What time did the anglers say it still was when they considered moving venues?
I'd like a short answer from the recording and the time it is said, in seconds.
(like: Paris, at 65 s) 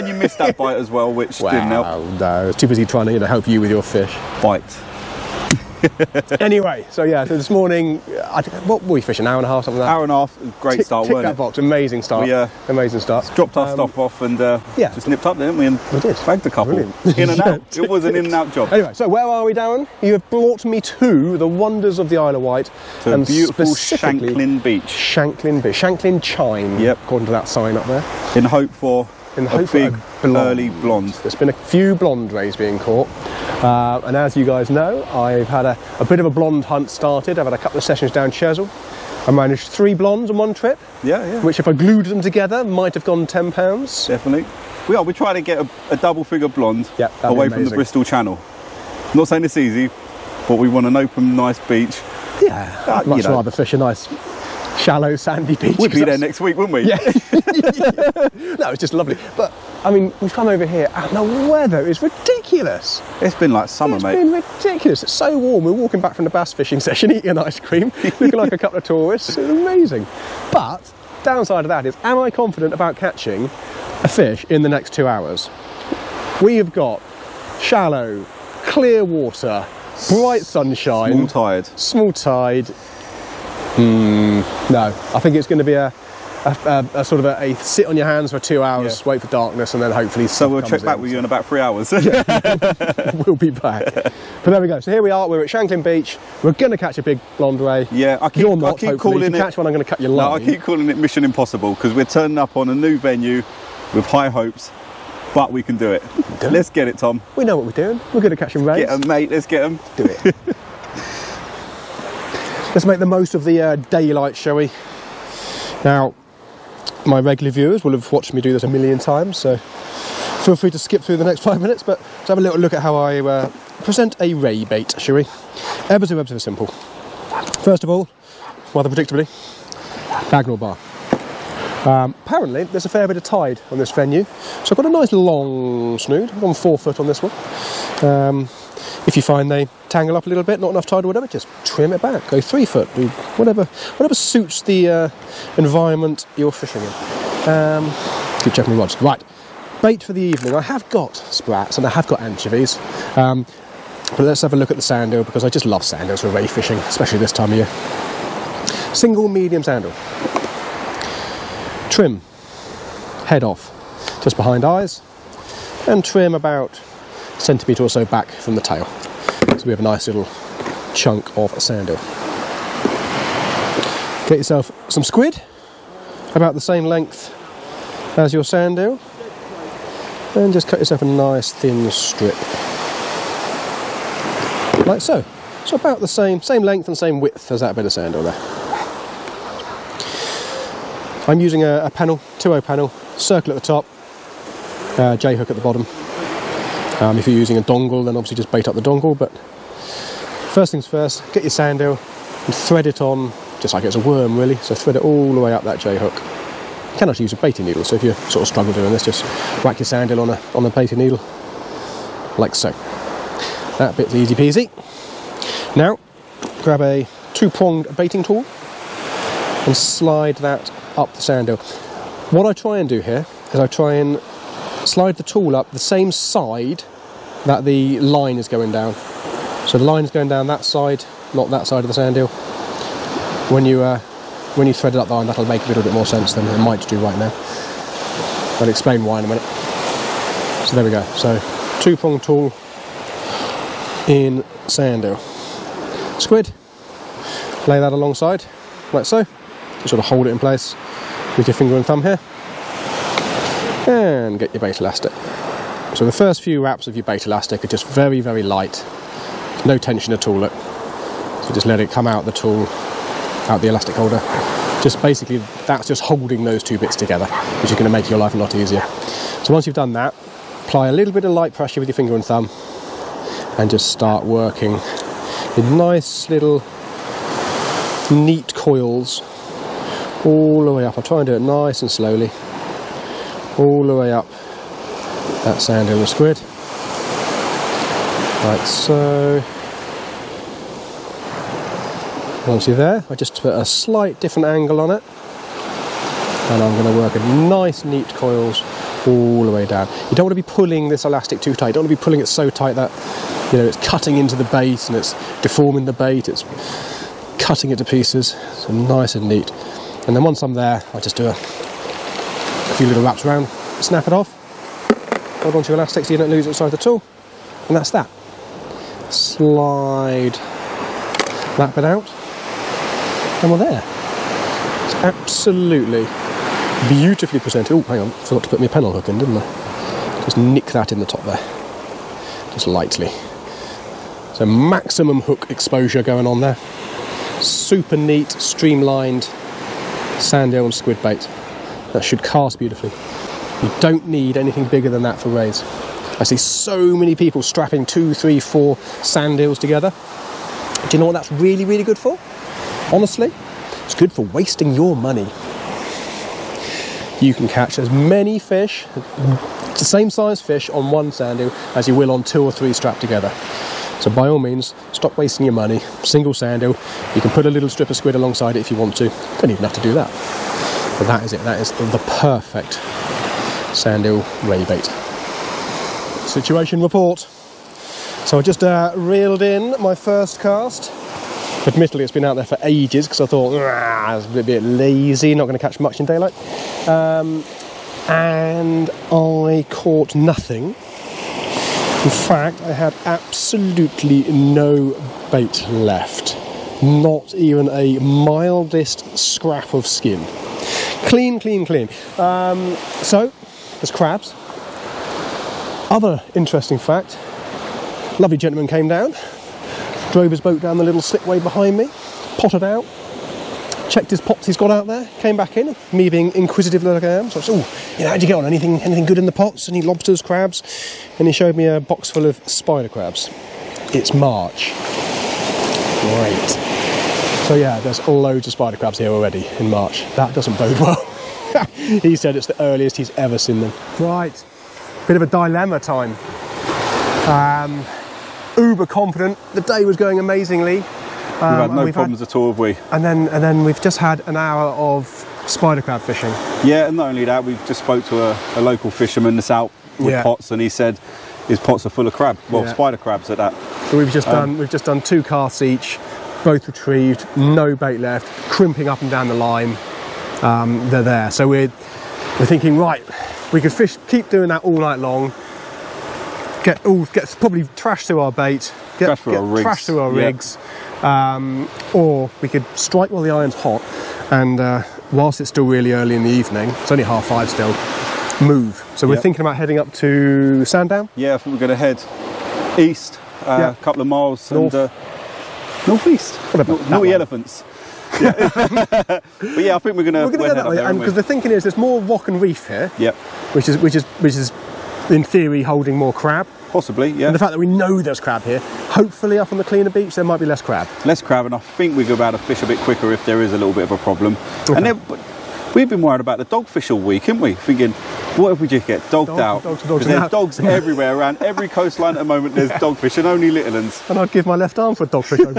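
half five, at 477 s.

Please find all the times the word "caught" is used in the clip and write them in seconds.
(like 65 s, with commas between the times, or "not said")
32 s, 389 s.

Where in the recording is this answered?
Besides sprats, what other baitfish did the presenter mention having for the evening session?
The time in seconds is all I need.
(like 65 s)
152 s.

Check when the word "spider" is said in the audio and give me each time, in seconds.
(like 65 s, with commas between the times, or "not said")
422 s, 428 s, 445 s, 452 s.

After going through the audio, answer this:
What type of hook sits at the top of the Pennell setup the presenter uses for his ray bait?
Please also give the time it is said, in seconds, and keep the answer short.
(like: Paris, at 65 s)
circle, at 193 s.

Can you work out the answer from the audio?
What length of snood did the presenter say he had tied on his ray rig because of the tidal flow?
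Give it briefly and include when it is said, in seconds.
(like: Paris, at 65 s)
4 foot, at 136 s.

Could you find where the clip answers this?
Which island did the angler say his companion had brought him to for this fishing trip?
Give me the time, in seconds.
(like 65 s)
22 s.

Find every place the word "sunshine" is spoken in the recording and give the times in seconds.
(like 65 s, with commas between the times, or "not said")
80 s.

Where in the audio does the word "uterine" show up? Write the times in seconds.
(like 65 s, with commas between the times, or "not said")
not said.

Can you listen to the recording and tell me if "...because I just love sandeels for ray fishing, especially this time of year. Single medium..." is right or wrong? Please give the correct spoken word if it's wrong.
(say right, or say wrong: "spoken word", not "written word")
right.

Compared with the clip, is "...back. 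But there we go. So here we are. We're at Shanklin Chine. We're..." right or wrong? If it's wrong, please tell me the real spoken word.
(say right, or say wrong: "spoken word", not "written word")
wrong: "Beach", not "Chine".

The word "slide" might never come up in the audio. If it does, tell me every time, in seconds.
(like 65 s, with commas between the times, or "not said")
219 s, 224 s, 319 s.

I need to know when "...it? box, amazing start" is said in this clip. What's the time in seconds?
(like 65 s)
11 s.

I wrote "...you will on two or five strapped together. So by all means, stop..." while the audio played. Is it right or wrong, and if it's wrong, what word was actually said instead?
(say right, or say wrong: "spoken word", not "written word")
wrong: "three", not "five".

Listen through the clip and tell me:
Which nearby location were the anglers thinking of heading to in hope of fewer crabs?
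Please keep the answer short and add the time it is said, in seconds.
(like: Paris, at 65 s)
Sandown, at 480 s.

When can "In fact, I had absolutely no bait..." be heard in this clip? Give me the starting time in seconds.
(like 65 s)
392 s.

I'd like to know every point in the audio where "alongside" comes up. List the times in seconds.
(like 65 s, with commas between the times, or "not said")
247 s, 368 s.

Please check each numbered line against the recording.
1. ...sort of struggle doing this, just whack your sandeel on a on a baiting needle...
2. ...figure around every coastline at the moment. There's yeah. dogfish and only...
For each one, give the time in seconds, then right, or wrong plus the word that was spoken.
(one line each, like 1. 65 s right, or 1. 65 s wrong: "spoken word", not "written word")
1. 208 s right
2. 510 s wrong: "everywhere", not "figure".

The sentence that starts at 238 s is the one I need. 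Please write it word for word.
I'll explain why in a minute.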